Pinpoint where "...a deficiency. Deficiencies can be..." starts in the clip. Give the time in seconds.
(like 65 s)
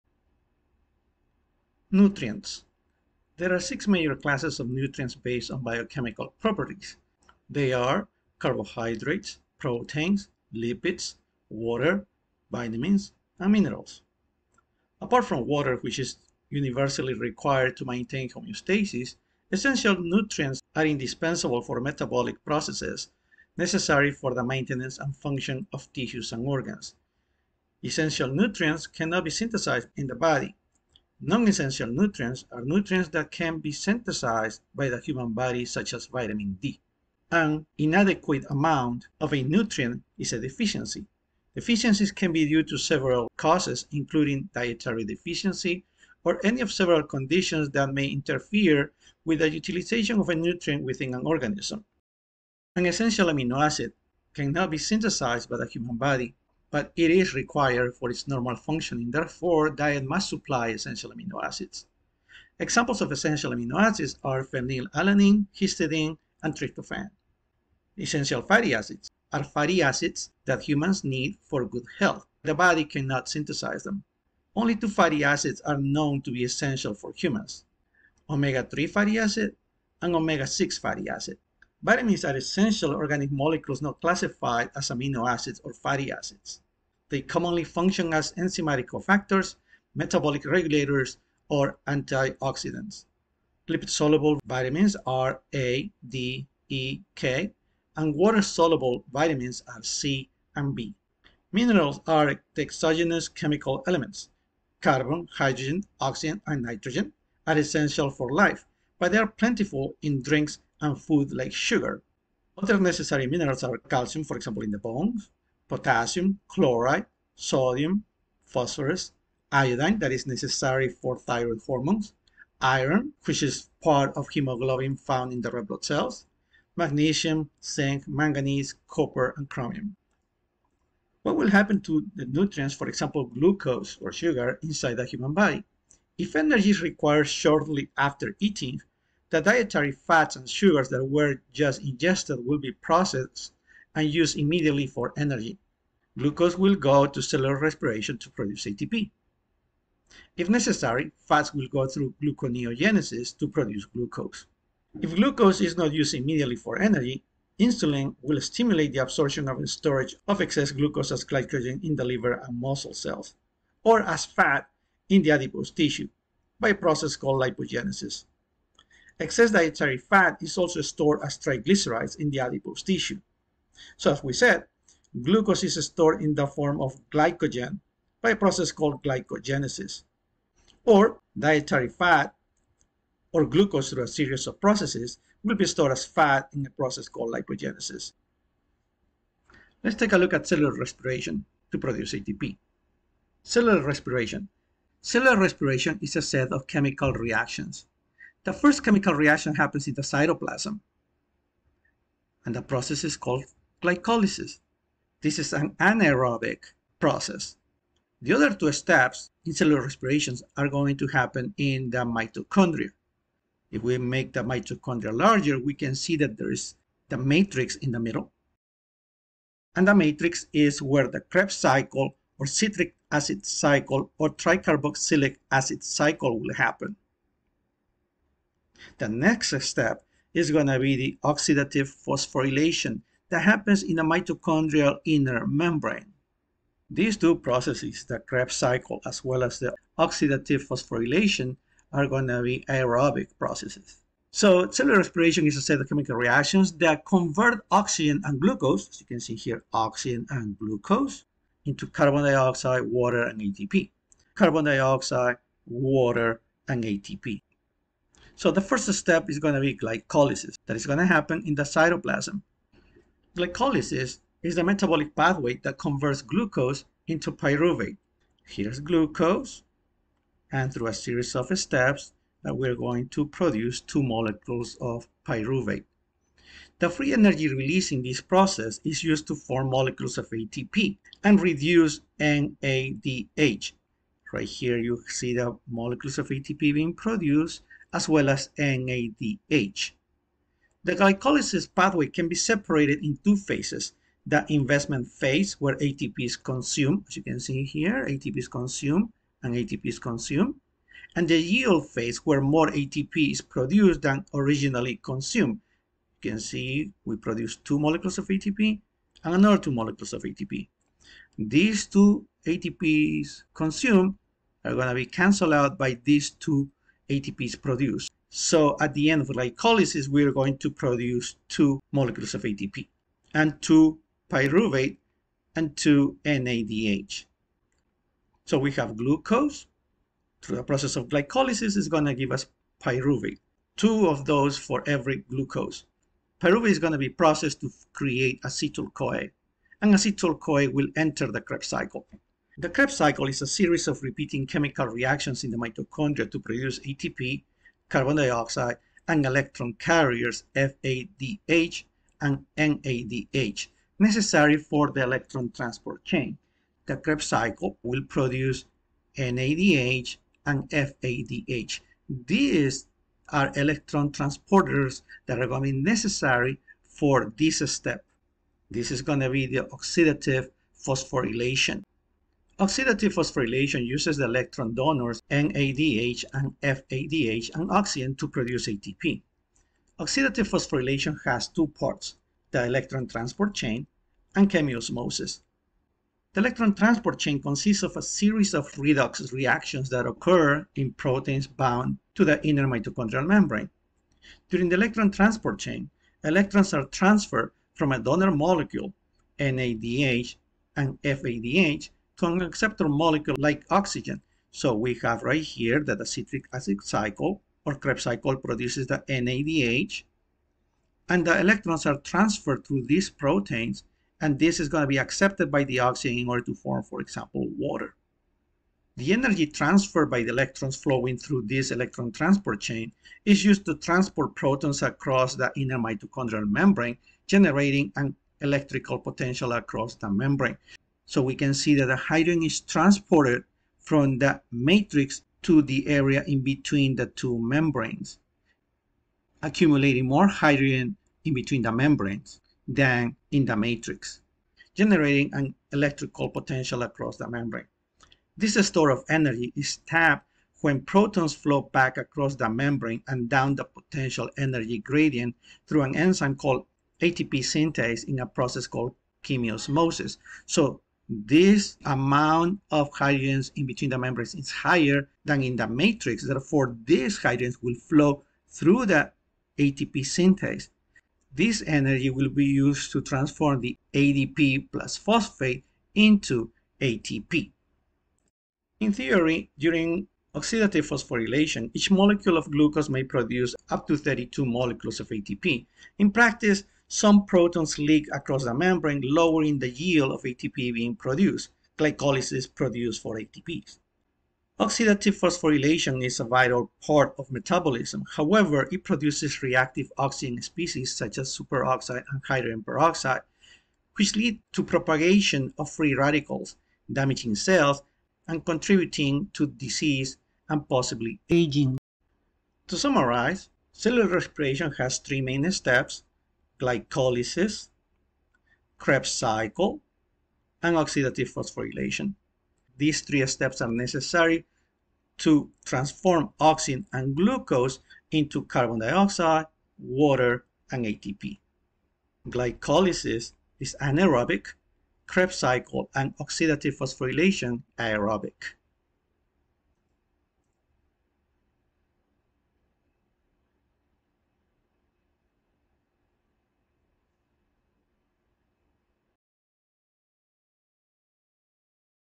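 40 s.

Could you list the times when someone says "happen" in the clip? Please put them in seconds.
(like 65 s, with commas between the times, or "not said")
131 s, 199 s, 211 s, 226 s, 233 s, 261 s.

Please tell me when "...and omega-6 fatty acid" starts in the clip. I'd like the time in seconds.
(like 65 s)
80 s.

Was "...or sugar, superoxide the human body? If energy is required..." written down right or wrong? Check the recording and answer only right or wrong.
wrong.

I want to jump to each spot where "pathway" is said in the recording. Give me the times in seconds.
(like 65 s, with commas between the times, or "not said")
265 s, 291 s.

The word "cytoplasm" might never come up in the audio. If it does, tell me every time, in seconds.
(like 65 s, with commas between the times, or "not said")
200 s, 261 s.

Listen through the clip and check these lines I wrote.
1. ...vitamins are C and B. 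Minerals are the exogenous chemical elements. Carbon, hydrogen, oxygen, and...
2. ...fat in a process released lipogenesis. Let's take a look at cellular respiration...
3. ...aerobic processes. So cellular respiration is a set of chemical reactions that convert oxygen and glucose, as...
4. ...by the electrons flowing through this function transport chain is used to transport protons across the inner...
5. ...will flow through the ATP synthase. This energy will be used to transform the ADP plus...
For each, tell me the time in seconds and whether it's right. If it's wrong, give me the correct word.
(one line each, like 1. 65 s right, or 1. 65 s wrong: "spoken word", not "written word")
1. 99 s right
2. 186 s wrong: "called", not "released"
3. 242 s right
4. 420 s wrong: "electron", not "function"
5. 467 s right.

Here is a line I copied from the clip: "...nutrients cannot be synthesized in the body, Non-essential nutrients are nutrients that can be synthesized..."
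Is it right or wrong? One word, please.
right.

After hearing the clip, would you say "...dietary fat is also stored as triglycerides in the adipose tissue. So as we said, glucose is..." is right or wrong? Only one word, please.
right.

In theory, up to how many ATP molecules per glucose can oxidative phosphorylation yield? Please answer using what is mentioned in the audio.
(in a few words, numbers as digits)
32.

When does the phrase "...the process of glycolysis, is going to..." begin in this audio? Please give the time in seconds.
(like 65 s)
330 s.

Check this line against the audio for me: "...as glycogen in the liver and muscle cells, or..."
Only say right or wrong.
right.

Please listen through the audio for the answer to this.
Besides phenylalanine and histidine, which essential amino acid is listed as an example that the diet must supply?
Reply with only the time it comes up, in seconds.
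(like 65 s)
66 s.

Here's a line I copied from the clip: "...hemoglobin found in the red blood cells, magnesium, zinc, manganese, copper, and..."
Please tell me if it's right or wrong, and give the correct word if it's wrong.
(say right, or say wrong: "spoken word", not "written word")
right.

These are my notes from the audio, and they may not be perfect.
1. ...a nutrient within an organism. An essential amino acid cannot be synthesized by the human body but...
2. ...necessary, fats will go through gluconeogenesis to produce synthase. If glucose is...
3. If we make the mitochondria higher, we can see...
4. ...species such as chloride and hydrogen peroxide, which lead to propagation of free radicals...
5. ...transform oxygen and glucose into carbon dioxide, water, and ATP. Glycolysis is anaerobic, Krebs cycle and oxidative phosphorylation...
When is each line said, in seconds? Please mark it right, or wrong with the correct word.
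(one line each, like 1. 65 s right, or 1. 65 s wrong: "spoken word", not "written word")
1. 50 s right
2. 150 s wrong: "glucose", not "synthase"
3. 213 s wrong: "larger", not "higher"
4. 500 s wrong: "superoxide", not "chloride"
5. 525 s right.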